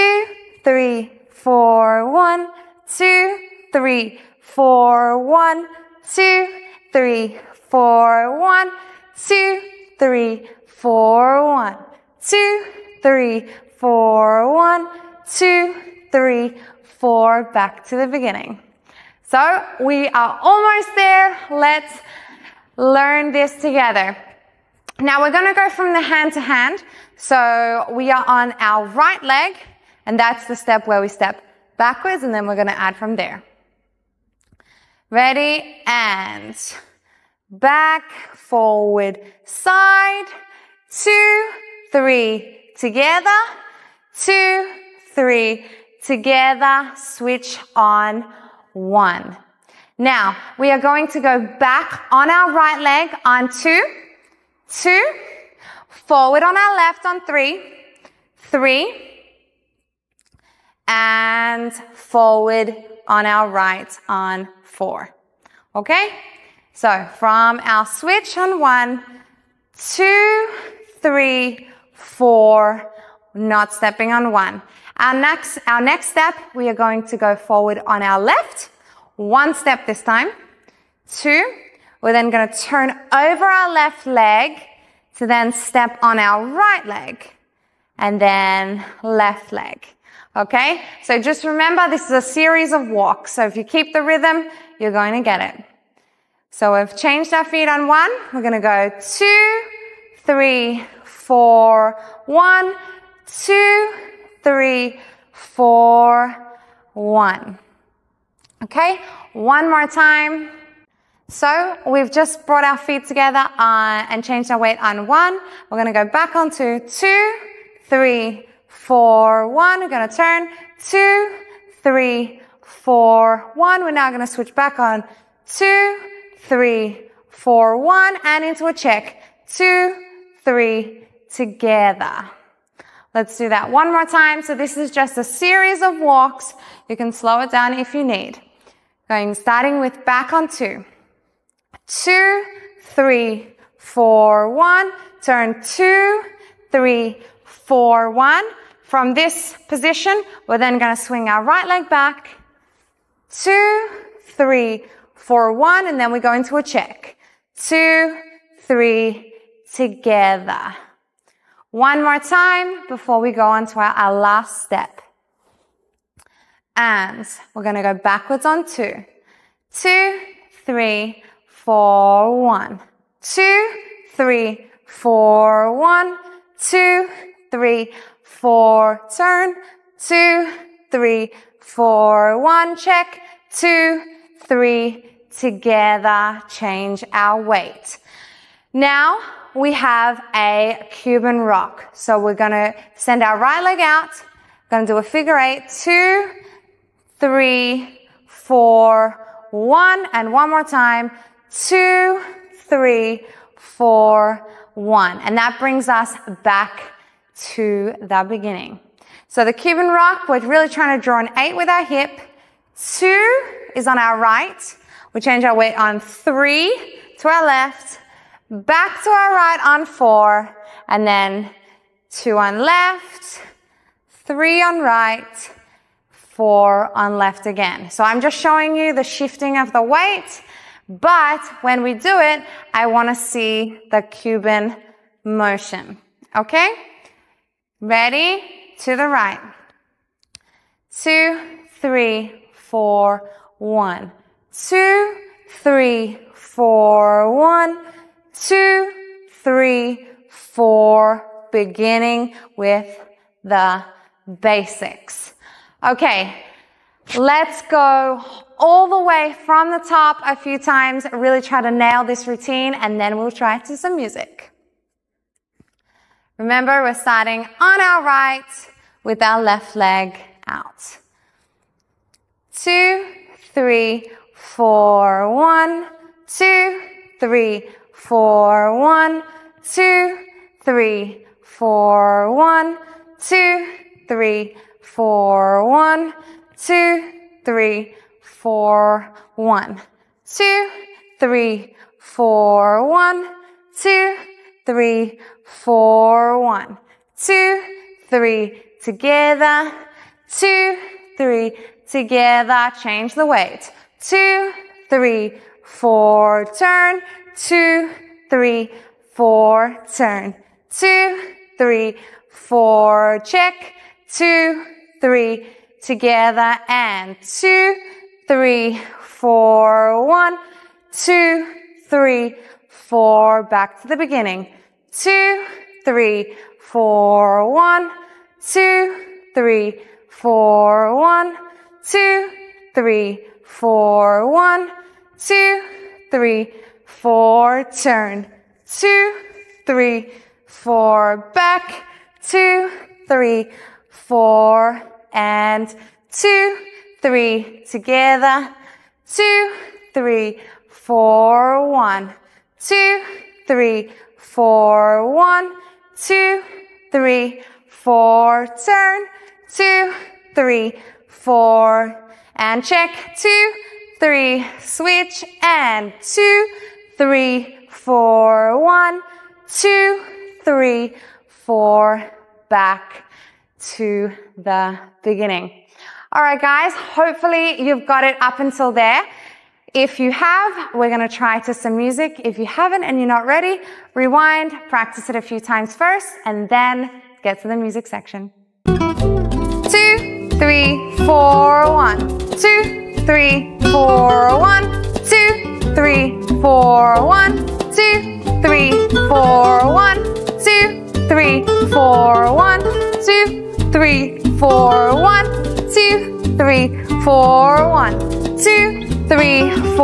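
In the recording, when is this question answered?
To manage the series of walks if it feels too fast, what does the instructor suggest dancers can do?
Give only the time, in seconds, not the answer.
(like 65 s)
137 s.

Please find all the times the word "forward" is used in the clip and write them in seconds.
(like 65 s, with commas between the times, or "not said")
38 s, 55 s, 61 s, 77 s.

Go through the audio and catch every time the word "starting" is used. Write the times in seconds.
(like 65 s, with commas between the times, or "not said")
139 s, 266 s.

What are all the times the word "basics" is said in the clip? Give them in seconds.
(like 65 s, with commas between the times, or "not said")
254 s.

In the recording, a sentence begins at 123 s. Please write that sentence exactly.
We're now going to switch back on two, three, four, one, and into a check.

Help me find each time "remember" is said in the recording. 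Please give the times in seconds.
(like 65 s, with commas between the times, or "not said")
91 s, 266 s.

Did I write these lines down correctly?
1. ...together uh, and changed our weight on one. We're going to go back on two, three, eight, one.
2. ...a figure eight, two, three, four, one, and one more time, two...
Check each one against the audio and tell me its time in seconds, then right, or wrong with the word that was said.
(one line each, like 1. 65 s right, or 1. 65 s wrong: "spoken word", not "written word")
1. 113 s wrong: "four", not "eight"
2. 194 s right.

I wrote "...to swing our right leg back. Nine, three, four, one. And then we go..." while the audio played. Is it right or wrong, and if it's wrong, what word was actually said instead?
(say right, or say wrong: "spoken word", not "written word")
wrong: "Two", not "Nine".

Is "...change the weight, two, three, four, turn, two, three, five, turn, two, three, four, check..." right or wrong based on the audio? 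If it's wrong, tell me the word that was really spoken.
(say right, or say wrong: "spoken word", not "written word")
wrong: "four", not "five".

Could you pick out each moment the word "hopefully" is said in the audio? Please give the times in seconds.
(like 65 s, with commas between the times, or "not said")
376 s.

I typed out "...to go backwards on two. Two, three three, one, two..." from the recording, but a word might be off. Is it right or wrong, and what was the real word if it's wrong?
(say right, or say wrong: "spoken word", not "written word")
wrong: "four", not "three".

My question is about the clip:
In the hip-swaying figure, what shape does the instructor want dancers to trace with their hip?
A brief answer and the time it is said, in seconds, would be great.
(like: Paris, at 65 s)
an eight, at 211 s.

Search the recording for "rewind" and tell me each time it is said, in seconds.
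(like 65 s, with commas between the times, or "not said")
383 s.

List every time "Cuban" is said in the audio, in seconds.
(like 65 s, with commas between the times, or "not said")
190 s, 209 s, 234 s.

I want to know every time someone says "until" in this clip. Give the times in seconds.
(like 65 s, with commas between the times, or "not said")
378 s.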